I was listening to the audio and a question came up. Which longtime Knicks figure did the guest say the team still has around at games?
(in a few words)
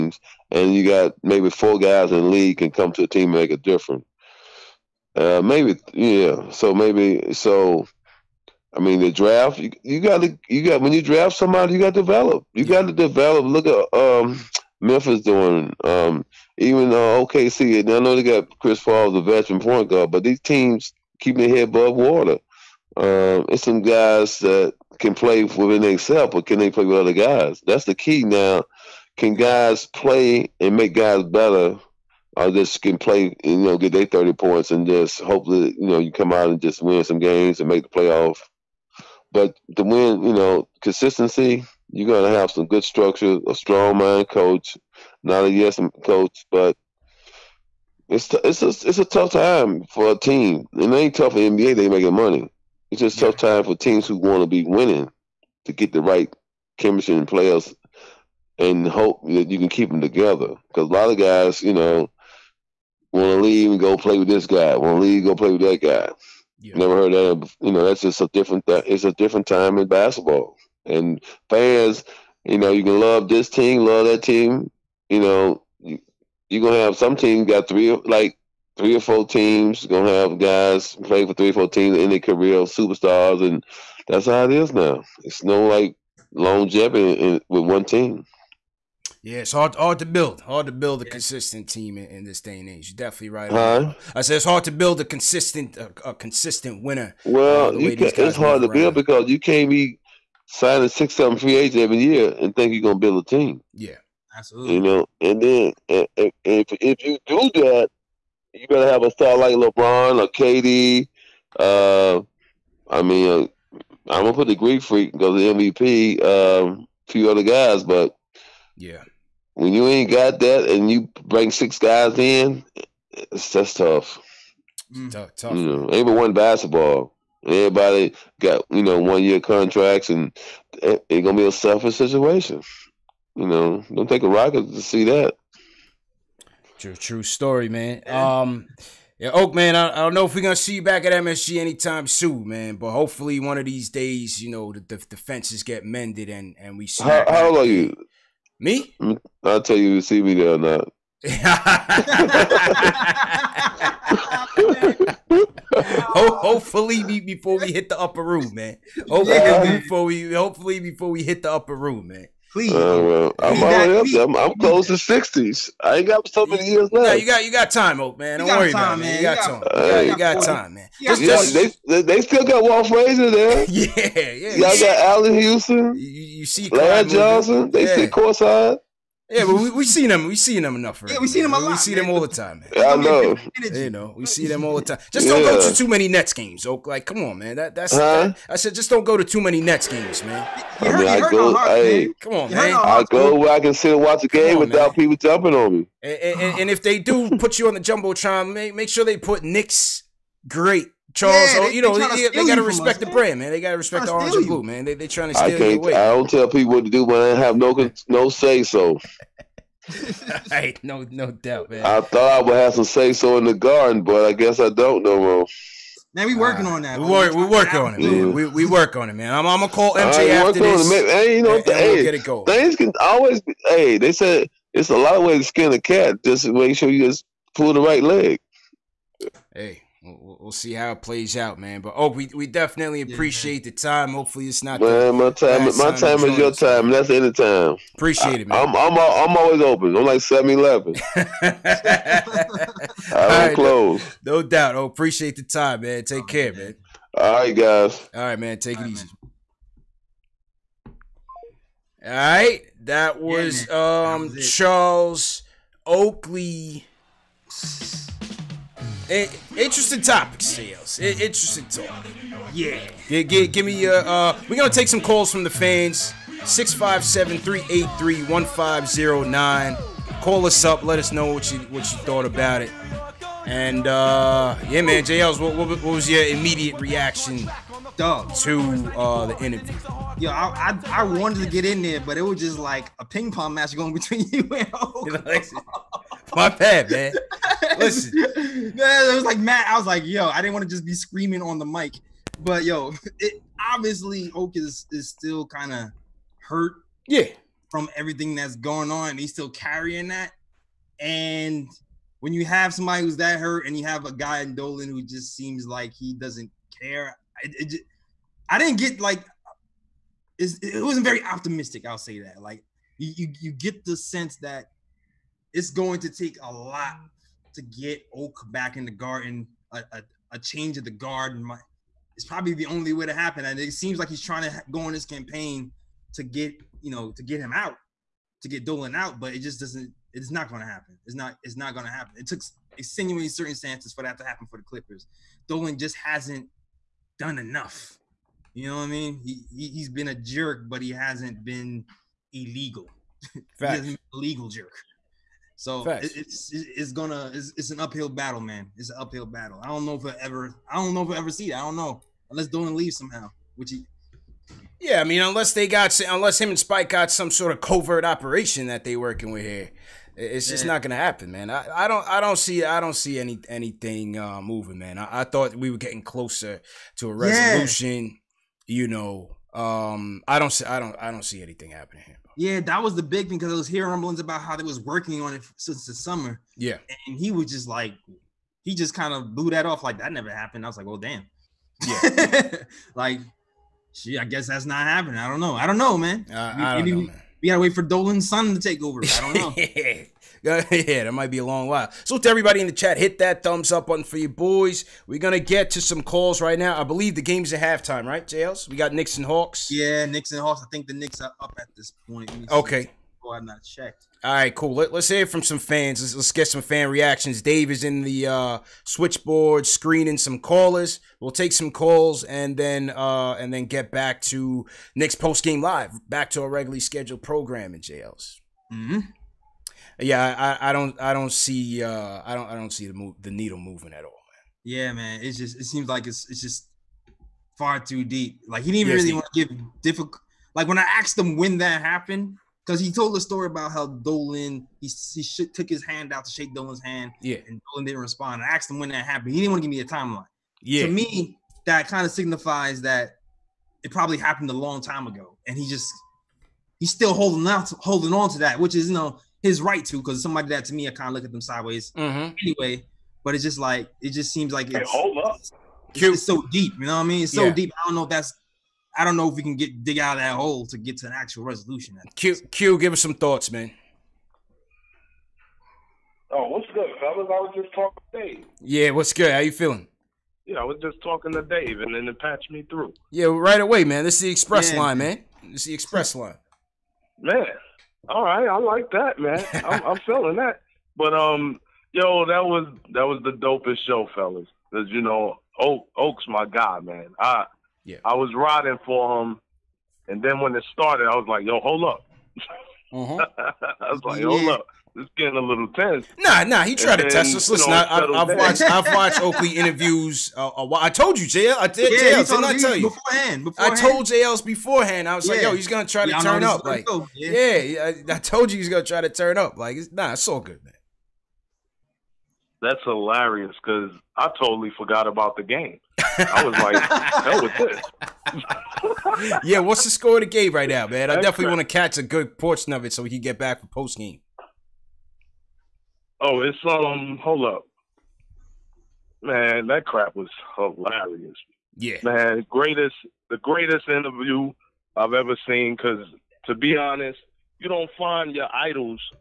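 Walt Frazier.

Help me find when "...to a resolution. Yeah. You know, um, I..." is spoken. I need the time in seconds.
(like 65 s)
366 s.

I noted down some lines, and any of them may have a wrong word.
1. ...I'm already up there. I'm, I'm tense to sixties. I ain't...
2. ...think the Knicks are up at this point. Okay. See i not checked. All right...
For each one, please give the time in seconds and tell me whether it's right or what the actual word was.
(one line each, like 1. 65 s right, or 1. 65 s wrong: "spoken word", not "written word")
1. 163 s wrong: "close", not "tense"
2. 400 s right.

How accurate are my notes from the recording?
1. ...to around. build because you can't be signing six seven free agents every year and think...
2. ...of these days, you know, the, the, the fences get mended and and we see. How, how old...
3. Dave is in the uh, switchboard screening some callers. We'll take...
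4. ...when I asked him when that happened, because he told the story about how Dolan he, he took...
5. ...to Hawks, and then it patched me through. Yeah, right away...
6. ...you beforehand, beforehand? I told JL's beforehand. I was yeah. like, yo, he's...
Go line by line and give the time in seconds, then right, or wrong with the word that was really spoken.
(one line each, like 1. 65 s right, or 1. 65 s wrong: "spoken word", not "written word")
1. 98 s right
2. 143 s right
3. 407 s right
4. 430 s right
5. 471 s wrong: "Dave", not "Hawks"
6. 502 s right.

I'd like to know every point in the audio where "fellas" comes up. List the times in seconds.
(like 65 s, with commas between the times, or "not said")
466 s, 484 s.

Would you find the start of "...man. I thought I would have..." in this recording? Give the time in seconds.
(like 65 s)
211 s.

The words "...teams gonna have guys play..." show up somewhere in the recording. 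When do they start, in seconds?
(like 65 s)
79 s.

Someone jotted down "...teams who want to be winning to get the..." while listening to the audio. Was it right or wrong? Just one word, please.
right.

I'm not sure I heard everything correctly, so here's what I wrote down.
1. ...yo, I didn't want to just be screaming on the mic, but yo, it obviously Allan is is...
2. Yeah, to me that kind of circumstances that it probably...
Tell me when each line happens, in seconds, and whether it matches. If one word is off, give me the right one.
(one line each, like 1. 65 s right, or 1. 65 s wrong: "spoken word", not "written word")
1. 290 s wrong: "Oak", not "Allan"
2. 440 s wrong: "signifies", not "circumstances".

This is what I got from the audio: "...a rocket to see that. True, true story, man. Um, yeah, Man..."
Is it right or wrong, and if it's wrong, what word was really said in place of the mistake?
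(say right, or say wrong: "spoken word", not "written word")
wrong: "Oak", not "Man".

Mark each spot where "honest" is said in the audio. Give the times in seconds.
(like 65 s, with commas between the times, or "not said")
536 s.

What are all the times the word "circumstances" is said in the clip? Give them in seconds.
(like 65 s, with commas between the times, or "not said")
333 s.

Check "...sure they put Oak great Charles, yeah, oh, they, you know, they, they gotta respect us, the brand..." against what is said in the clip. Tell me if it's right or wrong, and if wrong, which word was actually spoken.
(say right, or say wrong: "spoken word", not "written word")
wrong: "Knicks", not "Oak".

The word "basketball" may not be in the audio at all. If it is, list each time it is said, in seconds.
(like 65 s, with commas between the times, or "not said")
69 s, 126 s.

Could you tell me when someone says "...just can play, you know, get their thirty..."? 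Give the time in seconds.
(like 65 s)
32 s.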